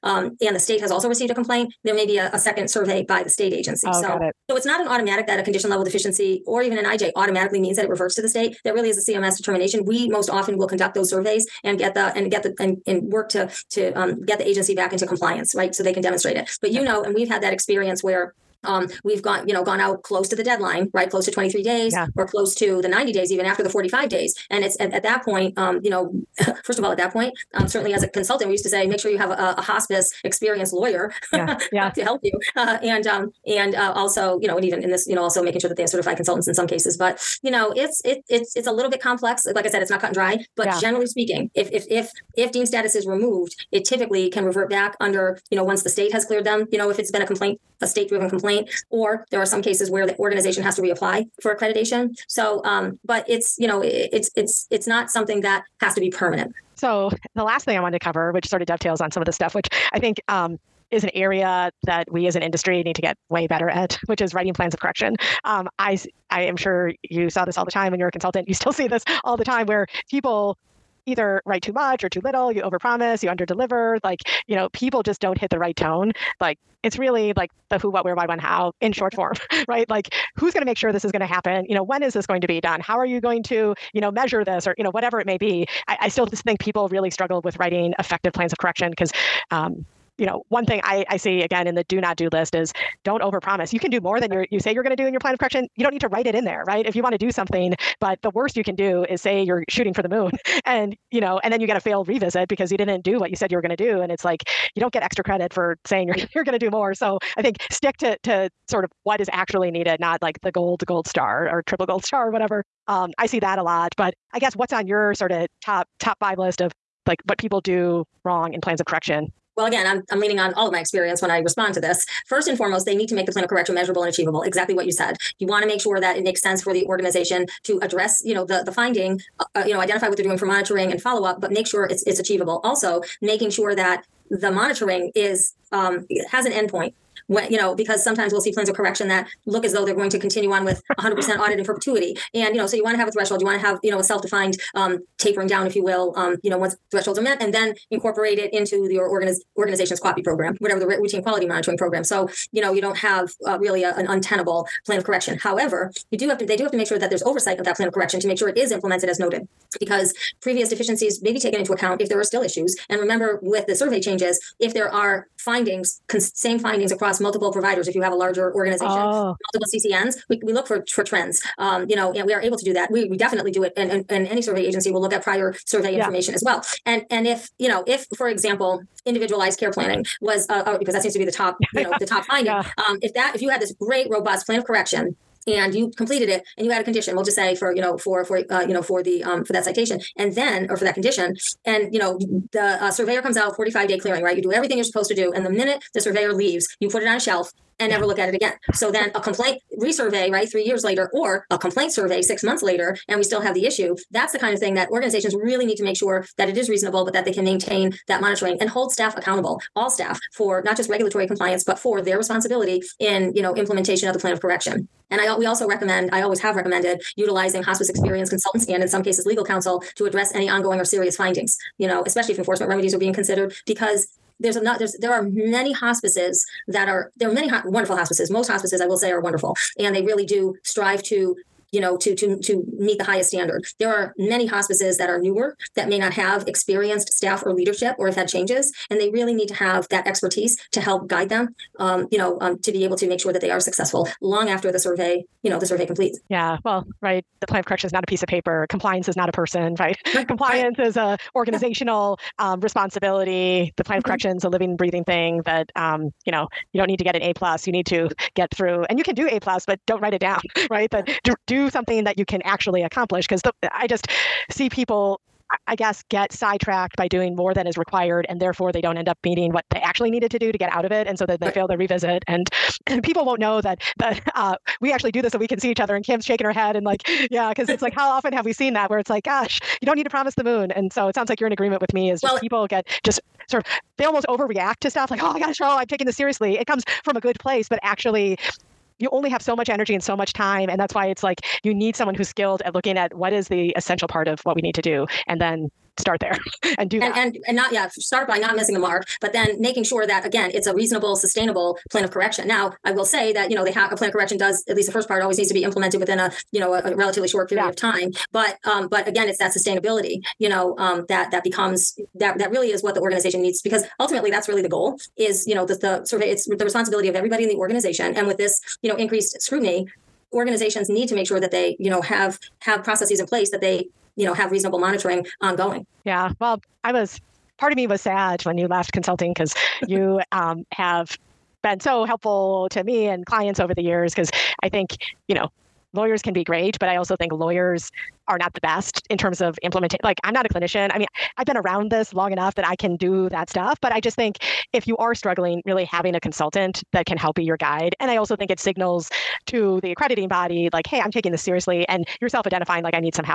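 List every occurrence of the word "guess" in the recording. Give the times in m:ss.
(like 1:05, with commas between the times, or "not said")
1:54, 4:25.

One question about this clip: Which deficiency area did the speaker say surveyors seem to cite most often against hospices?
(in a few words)
individualized care planning.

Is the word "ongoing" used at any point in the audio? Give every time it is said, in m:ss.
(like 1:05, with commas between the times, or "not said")
3:40, 5:25.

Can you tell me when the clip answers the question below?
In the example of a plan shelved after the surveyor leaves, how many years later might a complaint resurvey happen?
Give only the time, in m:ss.
3:20.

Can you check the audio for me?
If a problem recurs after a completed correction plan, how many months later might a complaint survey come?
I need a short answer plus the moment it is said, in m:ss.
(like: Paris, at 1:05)
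6, at 3:22.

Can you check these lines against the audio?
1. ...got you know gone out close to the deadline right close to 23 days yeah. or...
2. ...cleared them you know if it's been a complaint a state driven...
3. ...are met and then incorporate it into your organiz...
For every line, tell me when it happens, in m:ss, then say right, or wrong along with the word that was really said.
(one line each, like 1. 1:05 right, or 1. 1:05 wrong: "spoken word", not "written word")
1. 0:19 right
2. 0:46 right
3. 2:27 right.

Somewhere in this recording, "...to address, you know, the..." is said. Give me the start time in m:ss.
2:07.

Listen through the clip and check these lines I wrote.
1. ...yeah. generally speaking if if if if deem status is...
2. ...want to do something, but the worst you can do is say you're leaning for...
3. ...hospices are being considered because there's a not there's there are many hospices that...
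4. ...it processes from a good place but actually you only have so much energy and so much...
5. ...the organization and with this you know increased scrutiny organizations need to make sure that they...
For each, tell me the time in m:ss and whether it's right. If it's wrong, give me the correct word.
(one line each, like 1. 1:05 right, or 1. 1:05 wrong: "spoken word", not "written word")
1. 0:40 right
2. 1:37 wrong: "shooting", not "leaning"
3. 3:42 wrong: "remedies", not "hospices"
4. 4:46 wrong: "comes", not "processes"
5. 5:17 right.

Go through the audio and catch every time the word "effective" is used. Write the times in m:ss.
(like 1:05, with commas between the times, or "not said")
1:27.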